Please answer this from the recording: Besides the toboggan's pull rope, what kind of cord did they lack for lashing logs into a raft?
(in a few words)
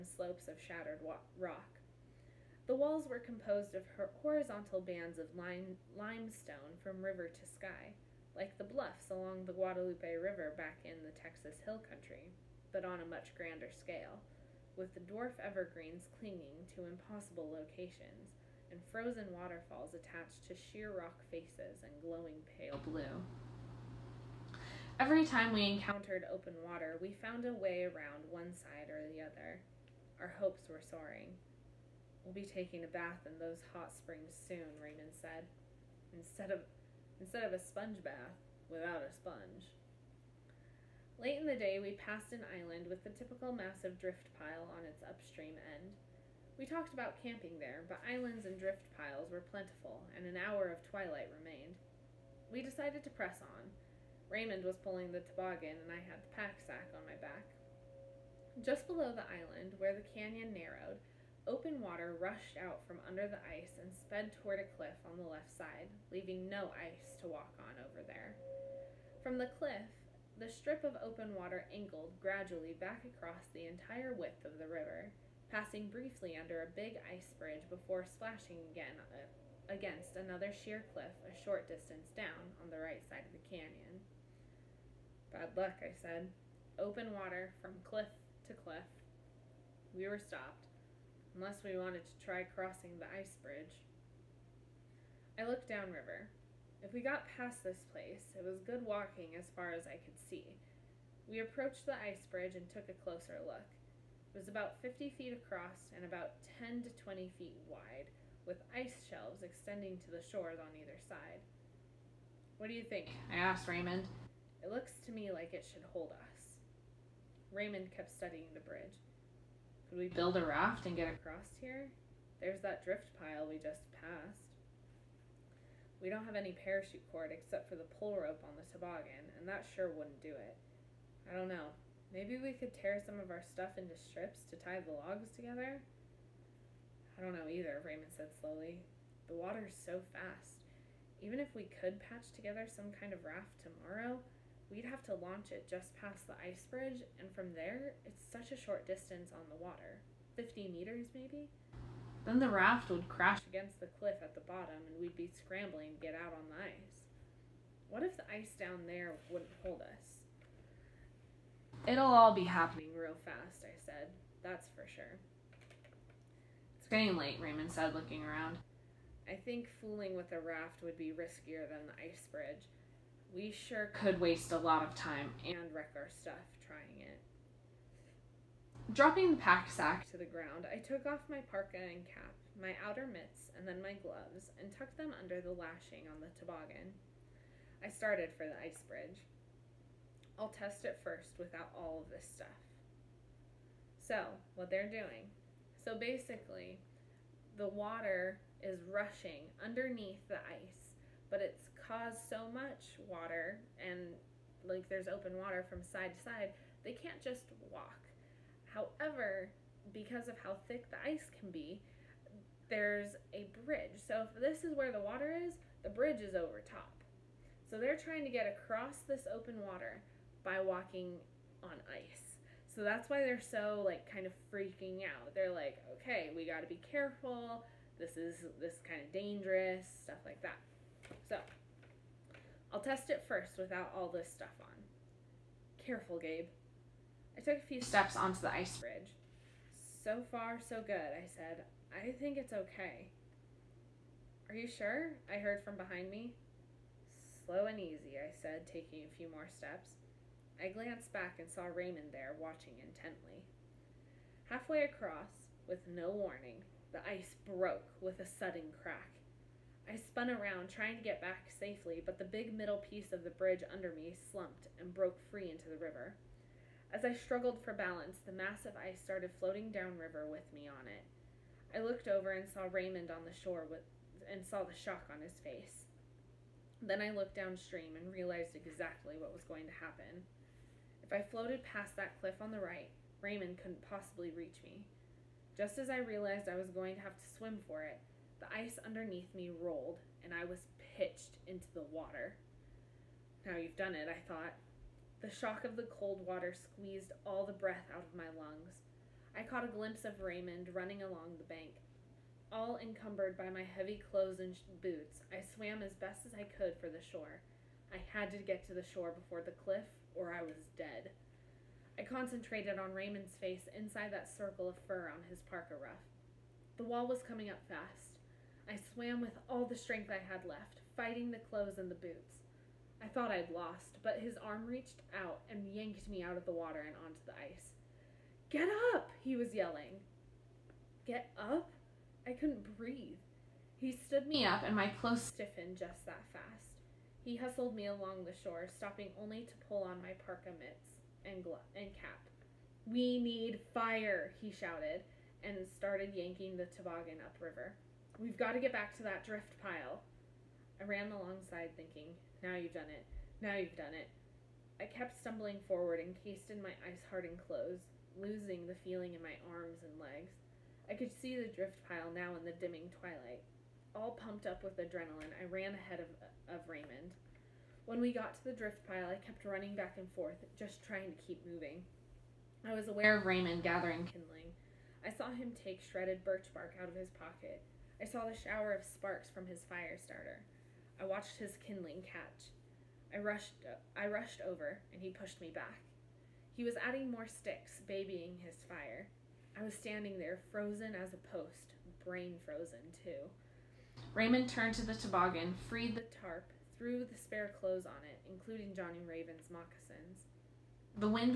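parachute cord.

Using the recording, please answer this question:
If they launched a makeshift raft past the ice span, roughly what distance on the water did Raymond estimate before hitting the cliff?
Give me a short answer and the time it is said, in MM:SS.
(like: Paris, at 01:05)
50 meters, at 02:30.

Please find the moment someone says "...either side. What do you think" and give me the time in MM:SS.
01:50.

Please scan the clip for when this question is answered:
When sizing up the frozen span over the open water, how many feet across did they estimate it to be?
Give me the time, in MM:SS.
01:44.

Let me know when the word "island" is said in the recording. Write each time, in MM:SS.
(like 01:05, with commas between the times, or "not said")
00:42, 00:48, 00:59.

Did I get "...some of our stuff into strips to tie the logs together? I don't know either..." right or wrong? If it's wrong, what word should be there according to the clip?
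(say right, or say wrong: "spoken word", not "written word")
right.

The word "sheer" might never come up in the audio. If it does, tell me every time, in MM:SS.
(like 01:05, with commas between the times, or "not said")
00:20, 01:20.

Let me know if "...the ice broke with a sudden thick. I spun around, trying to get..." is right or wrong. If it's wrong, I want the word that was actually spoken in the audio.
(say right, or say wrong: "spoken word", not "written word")
wrong: "crack", not "thick".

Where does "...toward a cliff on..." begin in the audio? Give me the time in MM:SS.
01:04.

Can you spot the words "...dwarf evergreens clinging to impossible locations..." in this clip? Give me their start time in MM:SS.
00:15.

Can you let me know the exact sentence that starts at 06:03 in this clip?
All pumped up with adrenaline, I ran ahead of, of Raymond.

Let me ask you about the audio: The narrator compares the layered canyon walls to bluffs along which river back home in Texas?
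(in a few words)
Guadalupe River.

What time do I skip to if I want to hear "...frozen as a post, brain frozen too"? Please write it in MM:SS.
06:30.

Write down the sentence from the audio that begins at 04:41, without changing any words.
If I floated past that cliff on the right, Raymond couldn't possibly reach me.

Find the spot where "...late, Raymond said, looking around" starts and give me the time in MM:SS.
02:47.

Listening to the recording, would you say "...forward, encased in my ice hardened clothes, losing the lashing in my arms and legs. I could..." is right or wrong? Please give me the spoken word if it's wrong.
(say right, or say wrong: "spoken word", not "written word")
wrong: "feeling", not "lashing".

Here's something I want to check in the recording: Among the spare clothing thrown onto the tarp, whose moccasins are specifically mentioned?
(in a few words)
Johnny Raven.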